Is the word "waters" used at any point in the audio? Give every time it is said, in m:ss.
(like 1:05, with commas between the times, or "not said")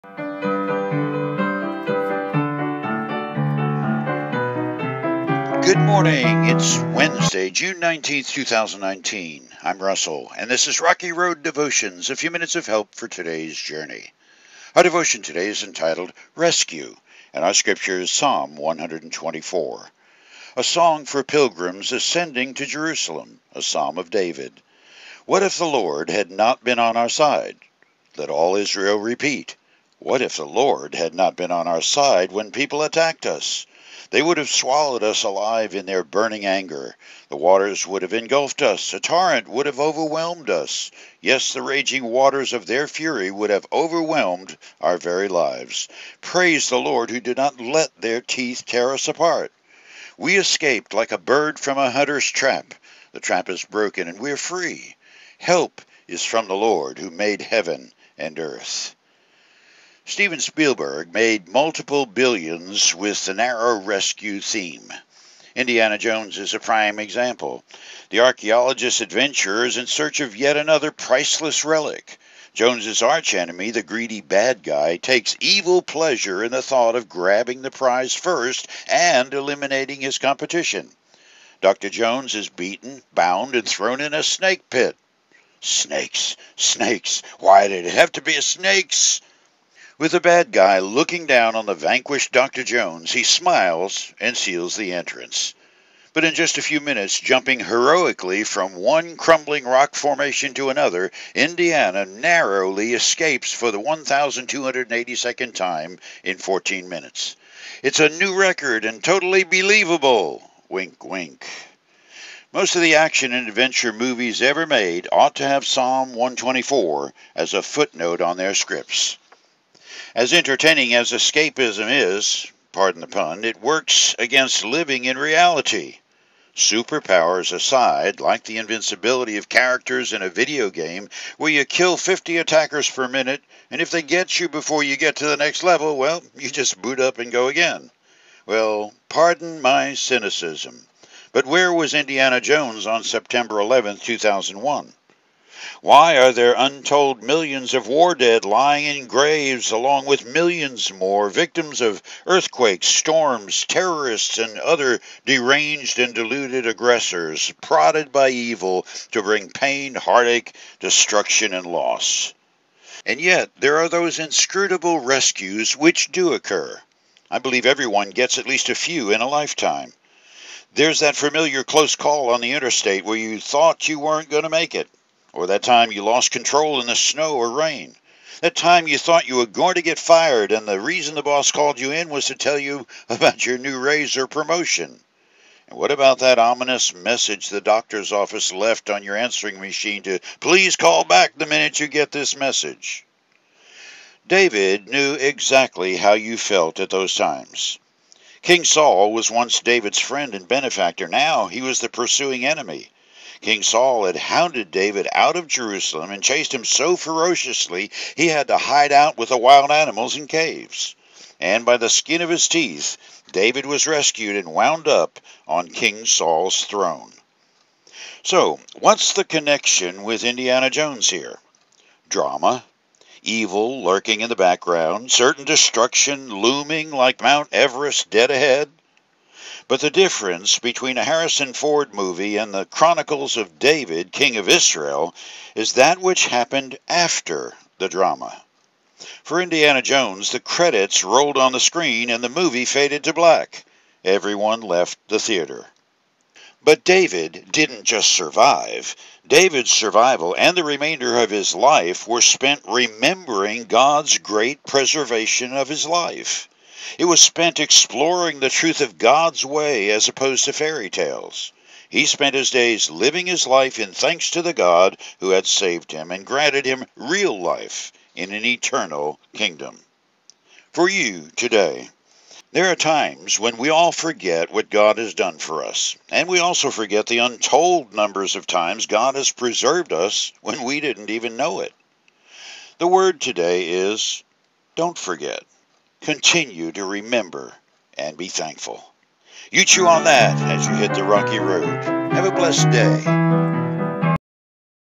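0:37, 0:42.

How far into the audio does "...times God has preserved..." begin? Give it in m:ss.
4:38.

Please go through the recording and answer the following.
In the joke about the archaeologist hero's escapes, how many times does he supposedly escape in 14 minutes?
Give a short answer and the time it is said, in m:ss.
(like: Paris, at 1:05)
1,282, at 1:43.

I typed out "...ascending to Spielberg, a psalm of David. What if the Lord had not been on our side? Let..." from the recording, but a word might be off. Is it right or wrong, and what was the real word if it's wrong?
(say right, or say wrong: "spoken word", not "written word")
wrong: "Jerusalem", not "Spielberg".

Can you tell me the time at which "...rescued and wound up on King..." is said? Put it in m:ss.
3:33.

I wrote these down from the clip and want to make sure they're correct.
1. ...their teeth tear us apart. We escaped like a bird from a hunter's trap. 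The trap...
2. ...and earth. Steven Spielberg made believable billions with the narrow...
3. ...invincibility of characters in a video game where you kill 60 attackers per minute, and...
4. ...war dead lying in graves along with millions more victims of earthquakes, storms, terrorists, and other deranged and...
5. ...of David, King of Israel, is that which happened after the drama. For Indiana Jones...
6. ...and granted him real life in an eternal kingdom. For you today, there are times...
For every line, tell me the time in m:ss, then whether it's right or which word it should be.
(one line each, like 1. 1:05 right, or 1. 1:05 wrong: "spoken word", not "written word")
1. 0:48 right
2. 0:58 wrong: "multiple", not "believable"
3. 2:08 wrong: "50", not "60"
4. 2:27 right
5. 3:53 right
6. 4:26 right.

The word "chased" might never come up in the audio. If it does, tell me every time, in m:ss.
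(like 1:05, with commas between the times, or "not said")
3:26.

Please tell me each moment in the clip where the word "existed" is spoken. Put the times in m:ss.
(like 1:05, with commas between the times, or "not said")
not said.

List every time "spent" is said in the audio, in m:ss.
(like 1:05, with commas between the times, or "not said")
4:12, 4:17, 4:22.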